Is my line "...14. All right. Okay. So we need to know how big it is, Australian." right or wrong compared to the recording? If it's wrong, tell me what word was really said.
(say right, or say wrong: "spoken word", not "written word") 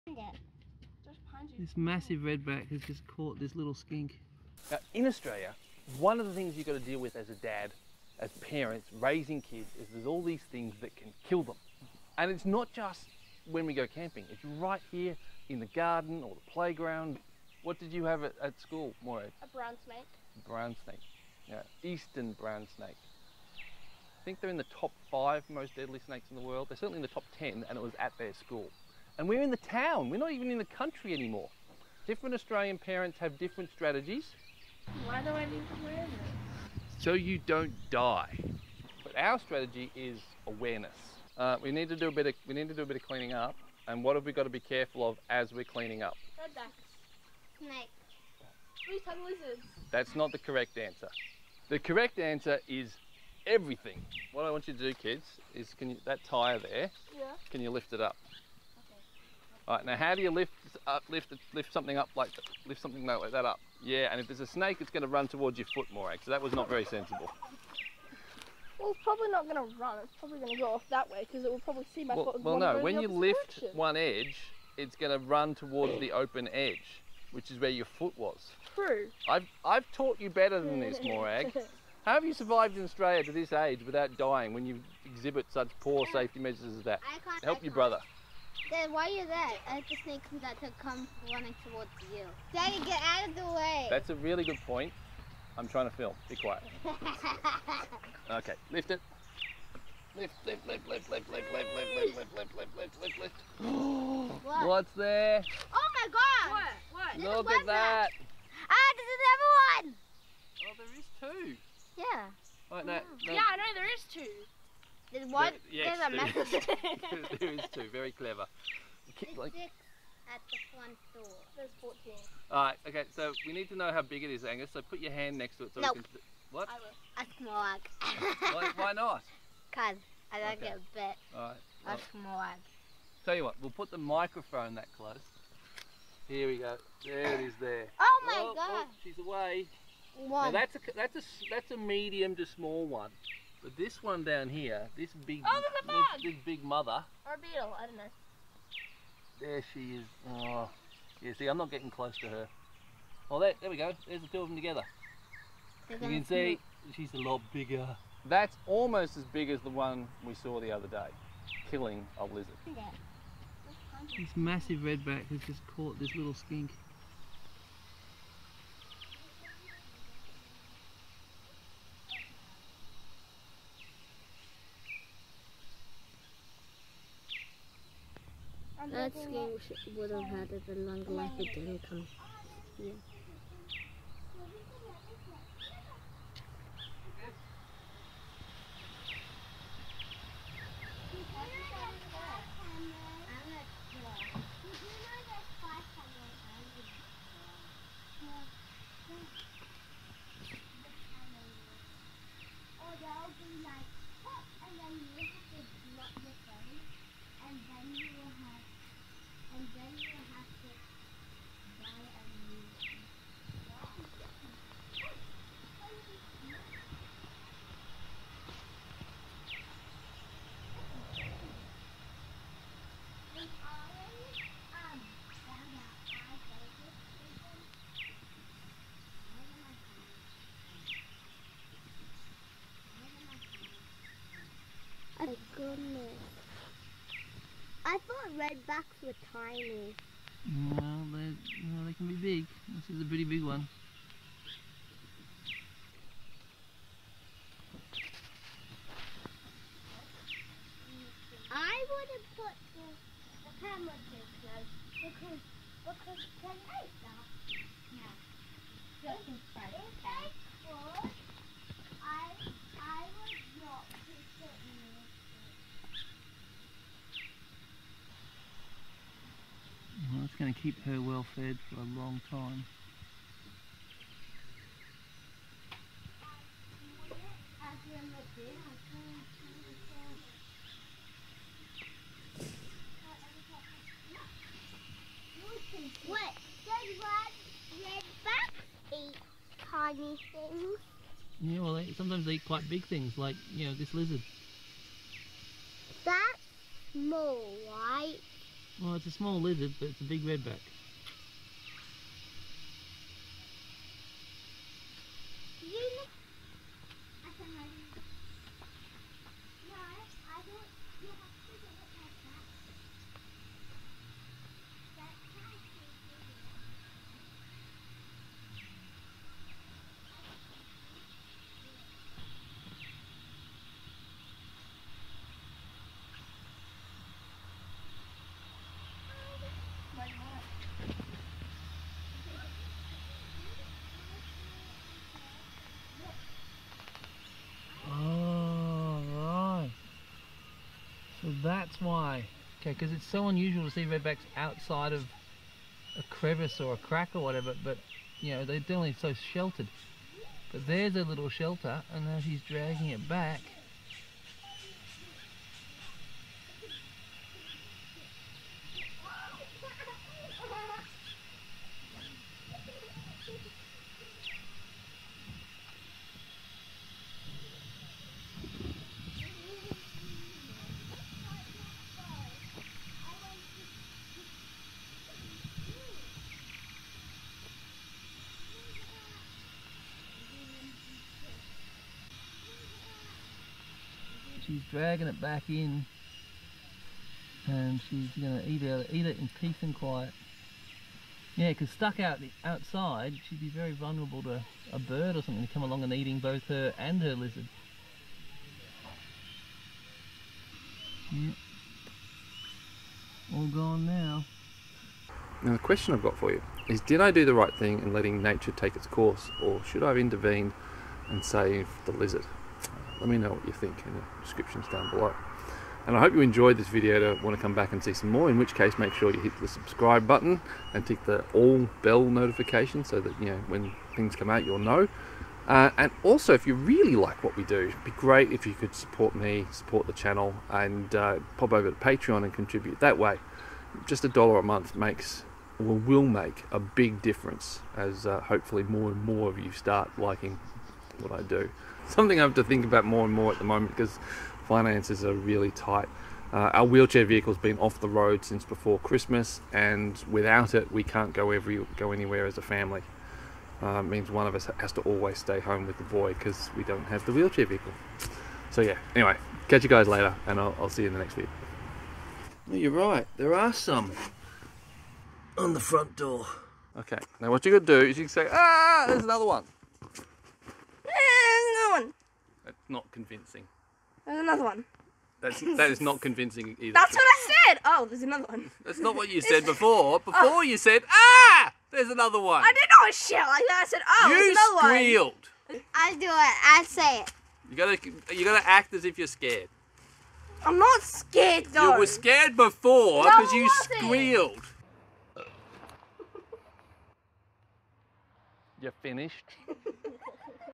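wrong: "Angus", not "Australian".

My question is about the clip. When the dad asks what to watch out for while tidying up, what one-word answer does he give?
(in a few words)
Everything.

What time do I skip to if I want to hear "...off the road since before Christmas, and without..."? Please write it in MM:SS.
07:27.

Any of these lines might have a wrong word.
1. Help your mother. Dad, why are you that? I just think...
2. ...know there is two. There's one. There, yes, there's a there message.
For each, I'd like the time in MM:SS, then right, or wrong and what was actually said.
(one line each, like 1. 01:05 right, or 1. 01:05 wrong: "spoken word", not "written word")
1. 01:27 wrong: "brother", not "mother"
2. 01:53 right.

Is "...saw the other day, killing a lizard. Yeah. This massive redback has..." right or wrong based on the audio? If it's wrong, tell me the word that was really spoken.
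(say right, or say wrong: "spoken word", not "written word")
right.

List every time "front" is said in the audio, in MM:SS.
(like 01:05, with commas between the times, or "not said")
02:00, 07:45.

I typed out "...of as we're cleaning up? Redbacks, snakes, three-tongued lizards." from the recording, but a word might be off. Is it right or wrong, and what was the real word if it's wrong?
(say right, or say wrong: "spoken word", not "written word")
right.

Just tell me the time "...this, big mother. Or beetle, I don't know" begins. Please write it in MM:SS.
02:26.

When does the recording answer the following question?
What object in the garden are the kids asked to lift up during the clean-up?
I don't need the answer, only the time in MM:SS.
00:56.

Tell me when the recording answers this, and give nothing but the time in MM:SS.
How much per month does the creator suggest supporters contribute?
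07:14.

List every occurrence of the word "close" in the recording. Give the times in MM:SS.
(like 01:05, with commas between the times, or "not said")
02:14, 02:31, 04:14.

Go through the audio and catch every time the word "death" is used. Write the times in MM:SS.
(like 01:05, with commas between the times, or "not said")
not said.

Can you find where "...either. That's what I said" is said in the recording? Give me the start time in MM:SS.
07:56.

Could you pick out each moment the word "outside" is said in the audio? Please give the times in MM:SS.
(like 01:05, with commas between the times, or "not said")
05:44, 06:32.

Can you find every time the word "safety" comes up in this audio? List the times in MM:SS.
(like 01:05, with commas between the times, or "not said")
01:26.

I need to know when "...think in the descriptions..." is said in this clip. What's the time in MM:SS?
06:53.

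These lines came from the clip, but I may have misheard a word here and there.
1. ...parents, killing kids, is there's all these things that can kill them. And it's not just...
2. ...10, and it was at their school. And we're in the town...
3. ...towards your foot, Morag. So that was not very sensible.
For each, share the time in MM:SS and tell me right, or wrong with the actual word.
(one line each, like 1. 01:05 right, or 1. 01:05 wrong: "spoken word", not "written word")
1. 00:08 wrong: "raising", not "killing"
2. 00:27 right
3. 01:05 right.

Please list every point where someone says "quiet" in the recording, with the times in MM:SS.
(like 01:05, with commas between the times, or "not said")
01:36, 06:29.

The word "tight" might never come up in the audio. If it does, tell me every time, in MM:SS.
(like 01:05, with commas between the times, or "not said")
07:25.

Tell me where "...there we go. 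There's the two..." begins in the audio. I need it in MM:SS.
02:33.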